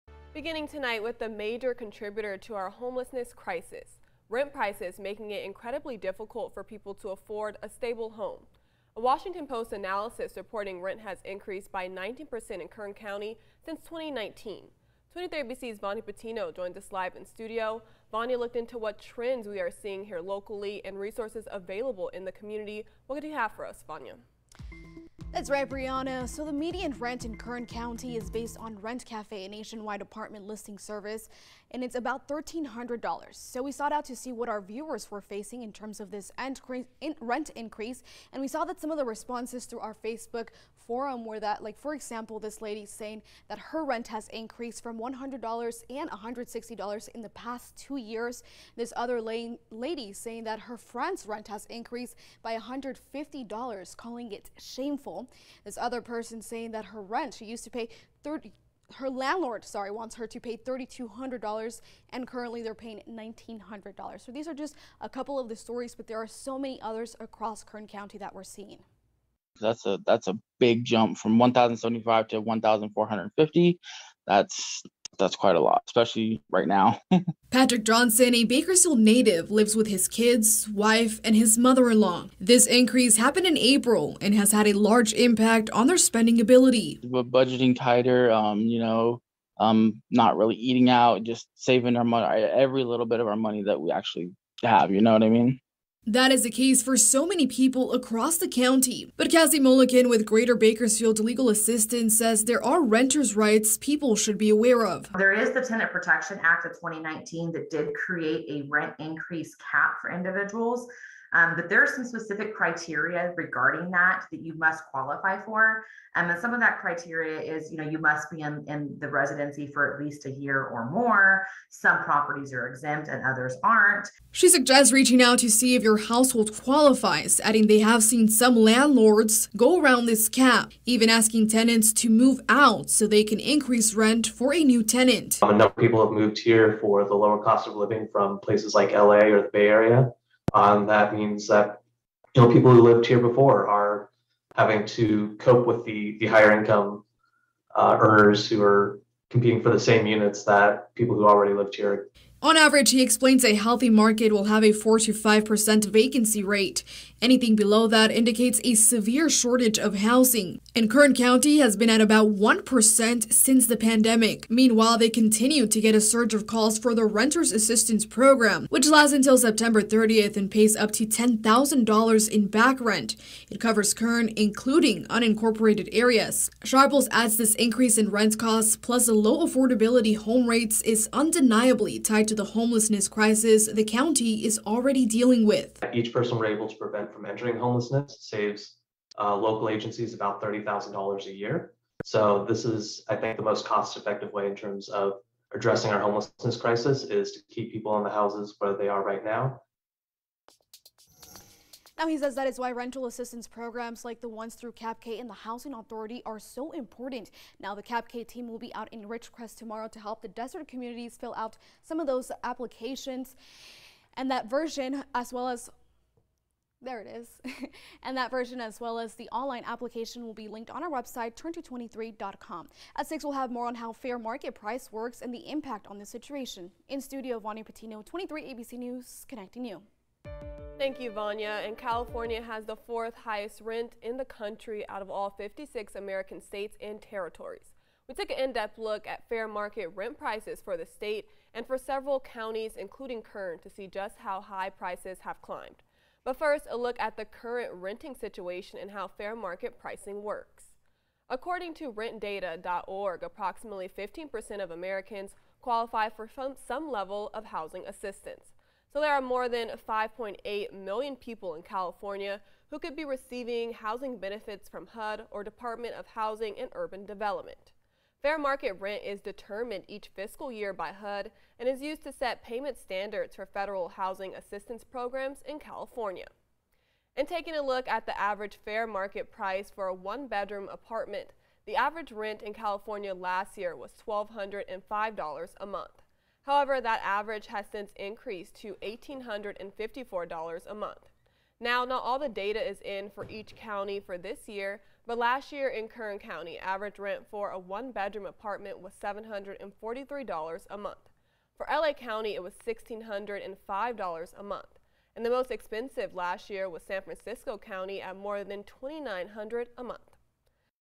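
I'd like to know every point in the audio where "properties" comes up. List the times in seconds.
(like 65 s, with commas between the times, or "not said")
122 s.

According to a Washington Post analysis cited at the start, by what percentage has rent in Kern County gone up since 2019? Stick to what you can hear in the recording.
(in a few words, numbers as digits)
19%.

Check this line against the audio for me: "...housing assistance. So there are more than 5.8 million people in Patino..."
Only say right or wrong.
wrong.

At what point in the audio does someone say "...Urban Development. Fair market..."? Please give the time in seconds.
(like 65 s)
266 s.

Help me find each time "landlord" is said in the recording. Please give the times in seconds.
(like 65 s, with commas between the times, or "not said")
59 s, 128 s.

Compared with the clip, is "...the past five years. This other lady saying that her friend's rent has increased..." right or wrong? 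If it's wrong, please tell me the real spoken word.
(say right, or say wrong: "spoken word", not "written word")
wrong: "two", not "five".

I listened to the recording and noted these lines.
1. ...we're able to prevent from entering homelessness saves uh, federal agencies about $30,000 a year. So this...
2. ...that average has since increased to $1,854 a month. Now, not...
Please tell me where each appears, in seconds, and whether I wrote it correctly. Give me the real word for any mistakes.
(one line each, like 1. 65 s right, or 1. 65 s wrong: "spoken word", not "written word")
1. 186 s wrong: "local", not "federal"
2. 286 s right.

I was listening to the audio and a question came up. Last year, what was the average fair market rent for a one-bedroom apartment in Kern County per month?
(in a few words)
$743.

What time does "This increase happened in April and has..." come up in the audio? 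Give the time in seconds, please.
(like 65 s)
82 s.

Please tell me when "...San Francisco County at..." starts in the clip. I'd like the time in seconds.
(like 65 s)
306 s.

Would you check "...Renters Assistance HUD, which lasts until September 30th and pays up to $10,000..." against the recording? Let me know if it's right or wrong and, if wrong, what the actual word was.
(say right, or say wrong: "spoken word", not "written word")
wrong: "Program", not "HUD".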